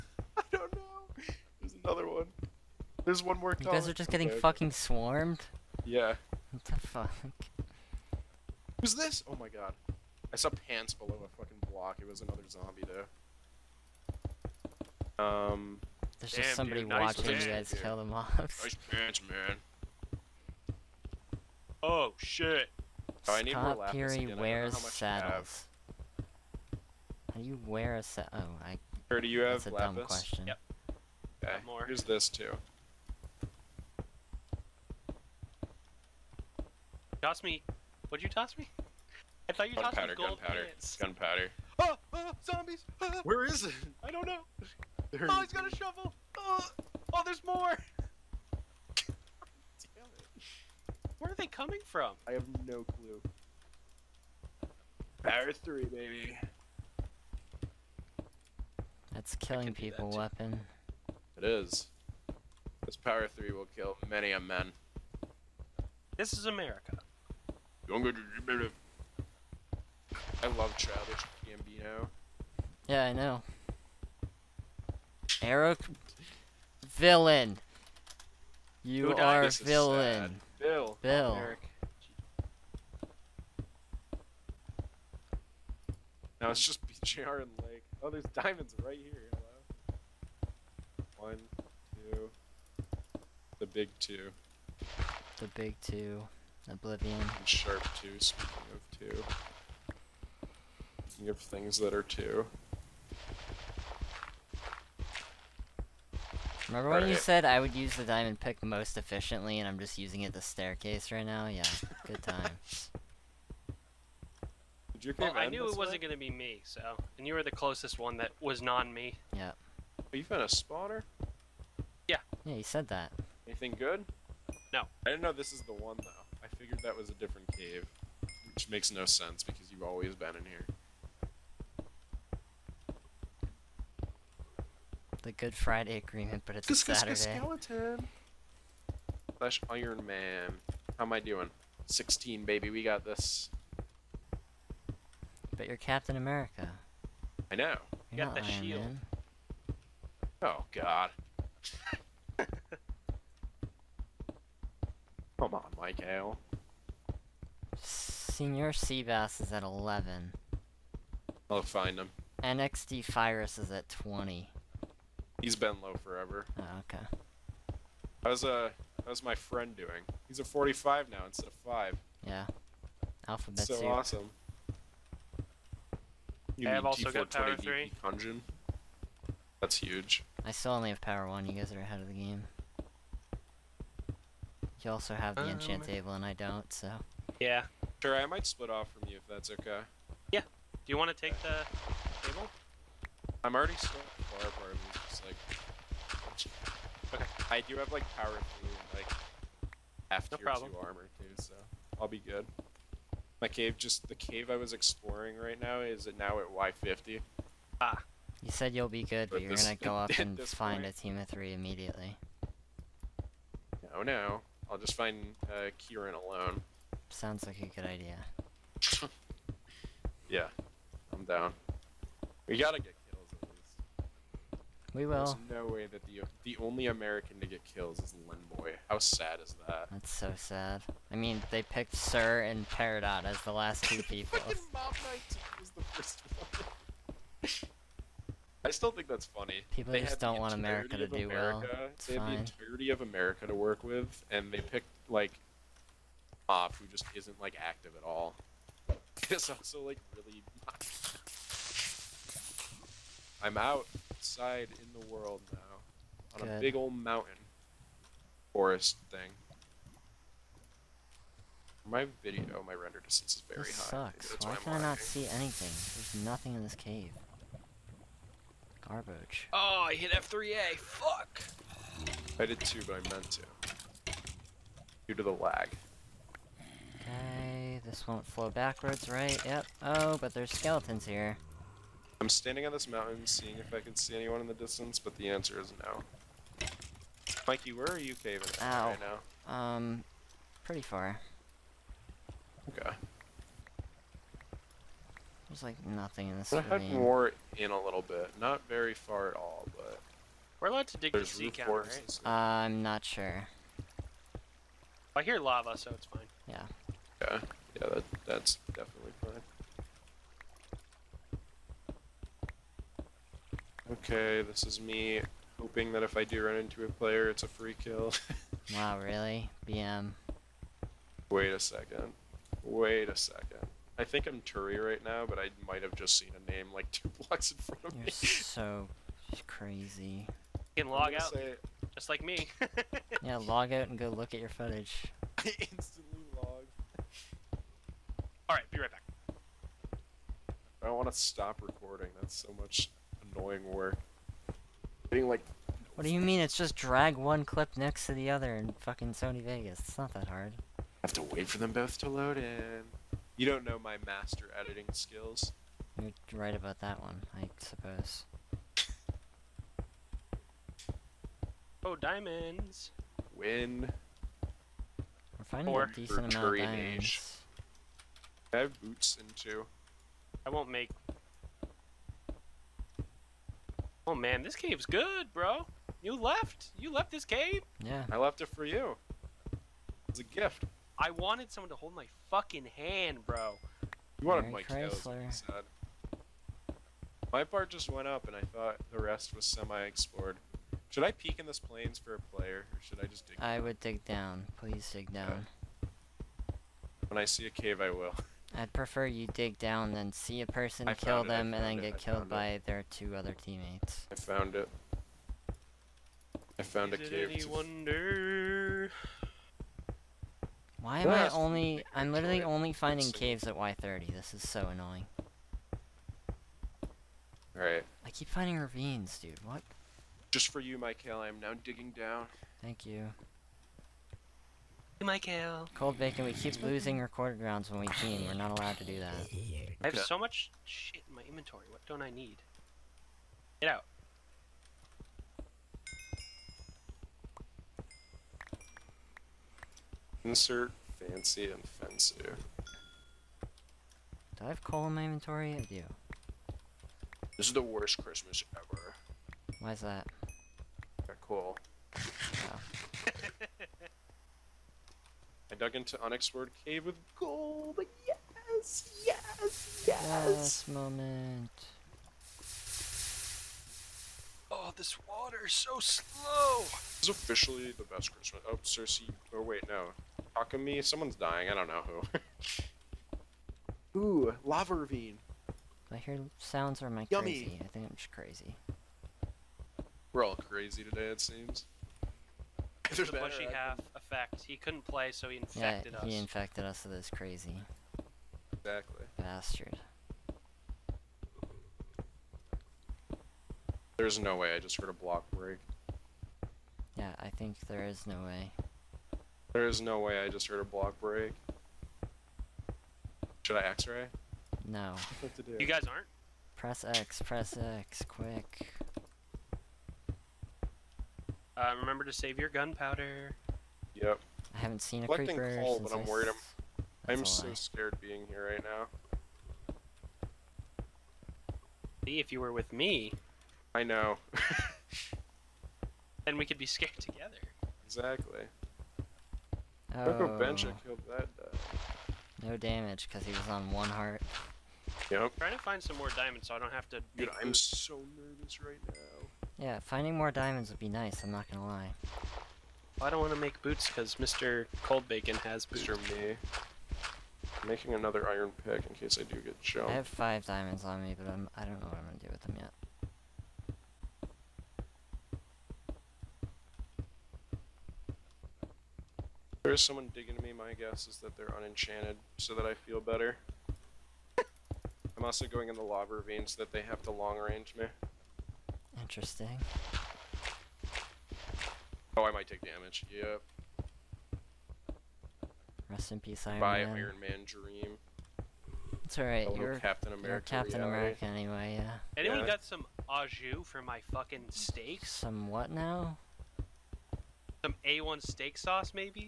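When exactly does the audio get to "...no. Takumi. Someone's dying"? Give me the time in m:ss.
7:49.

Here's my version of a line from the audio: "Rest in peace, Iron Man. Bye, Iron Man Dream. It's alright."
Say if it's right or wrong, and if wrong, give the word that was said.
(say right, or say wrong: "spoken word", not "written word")
right.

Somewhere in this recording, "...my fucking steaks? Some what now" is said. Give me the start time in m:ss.
9:43.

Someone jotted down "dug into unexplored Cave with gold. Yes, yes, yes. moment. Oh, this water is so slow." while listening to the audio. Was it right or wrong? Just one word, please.
right.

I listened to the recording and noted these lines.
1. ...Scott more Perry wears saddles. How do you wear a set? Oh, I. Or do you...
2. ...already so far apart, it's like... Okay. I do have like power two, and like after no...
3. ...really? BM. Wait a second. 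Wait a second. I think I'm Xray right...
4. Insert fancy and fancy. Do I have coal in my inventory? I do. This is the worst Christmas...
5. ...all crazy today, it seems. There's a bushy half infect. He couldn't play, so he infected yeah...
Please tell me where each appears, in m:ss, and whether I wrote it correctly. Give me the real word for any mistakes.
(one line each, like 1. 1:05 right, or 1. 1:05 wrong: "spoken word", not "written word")
1. 0:23 right
2. 3:13 right
3. 5:19 wrong: "Turi", not "Xray"
4. 7:20 right
5. 8:00 right.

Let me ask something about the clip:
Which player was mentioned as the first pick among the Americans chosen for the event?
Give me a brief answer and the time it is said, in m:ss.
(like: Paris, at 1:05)
Mob Knight, at 3:54.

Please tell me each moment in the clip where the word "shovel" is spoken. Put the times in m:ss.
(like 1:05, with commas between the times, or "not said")
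0:45.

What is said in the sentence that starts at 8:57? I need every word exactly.
Dude, I'm so nervous right now.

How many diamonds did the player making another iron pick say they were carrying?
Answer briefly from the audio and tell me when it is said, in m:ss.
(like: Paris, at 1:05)
5, at 9:10.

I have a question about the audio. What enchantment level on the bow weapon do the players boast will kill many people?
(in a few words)
Power 3.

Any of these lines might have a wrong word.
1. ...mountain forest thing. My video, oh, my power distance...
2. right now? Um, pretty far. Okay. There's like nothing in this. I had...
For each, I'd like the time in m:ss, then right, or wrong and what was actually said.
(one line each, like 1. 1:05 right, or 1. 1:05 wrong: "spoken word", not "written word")
1. 4:16 wrong: "render", not "power"
2. 4:48 right.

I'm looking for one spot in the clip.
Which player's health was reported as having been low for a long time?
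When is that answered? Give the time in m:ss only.
2:42.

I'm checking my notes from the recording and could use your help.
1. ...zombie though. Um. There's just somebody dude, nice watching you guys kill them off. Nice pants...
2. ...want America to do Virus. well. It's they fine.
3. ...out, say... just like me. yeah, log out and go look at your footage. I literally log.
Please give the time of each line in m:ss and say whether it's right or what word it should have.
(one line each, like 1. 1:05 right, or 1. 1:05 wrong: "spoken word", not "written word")
1. 0:12 right
2. 4:00 wrong: "America", not "Virus"
3. 5:31 wrong: "instantly", not "literally".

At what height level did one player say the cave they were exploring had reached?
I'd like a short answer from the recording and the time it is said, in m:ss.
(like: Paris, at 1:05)
Y50, at 3:26.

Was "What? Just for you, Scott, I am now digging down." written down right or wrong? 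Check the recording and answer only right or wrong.
wrong.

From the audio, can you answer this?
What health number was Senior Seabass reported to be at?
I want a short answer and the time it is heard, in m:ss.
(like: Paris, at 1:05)
11, at 2:39.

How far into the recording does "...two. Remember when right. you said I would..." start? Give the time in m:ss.
1:42.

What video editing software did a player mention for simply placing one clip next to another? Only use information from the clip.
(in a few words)
Sony Vegas.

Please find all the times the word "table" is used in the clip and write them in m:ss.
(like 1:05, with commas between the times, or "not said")
3:05, 3:12.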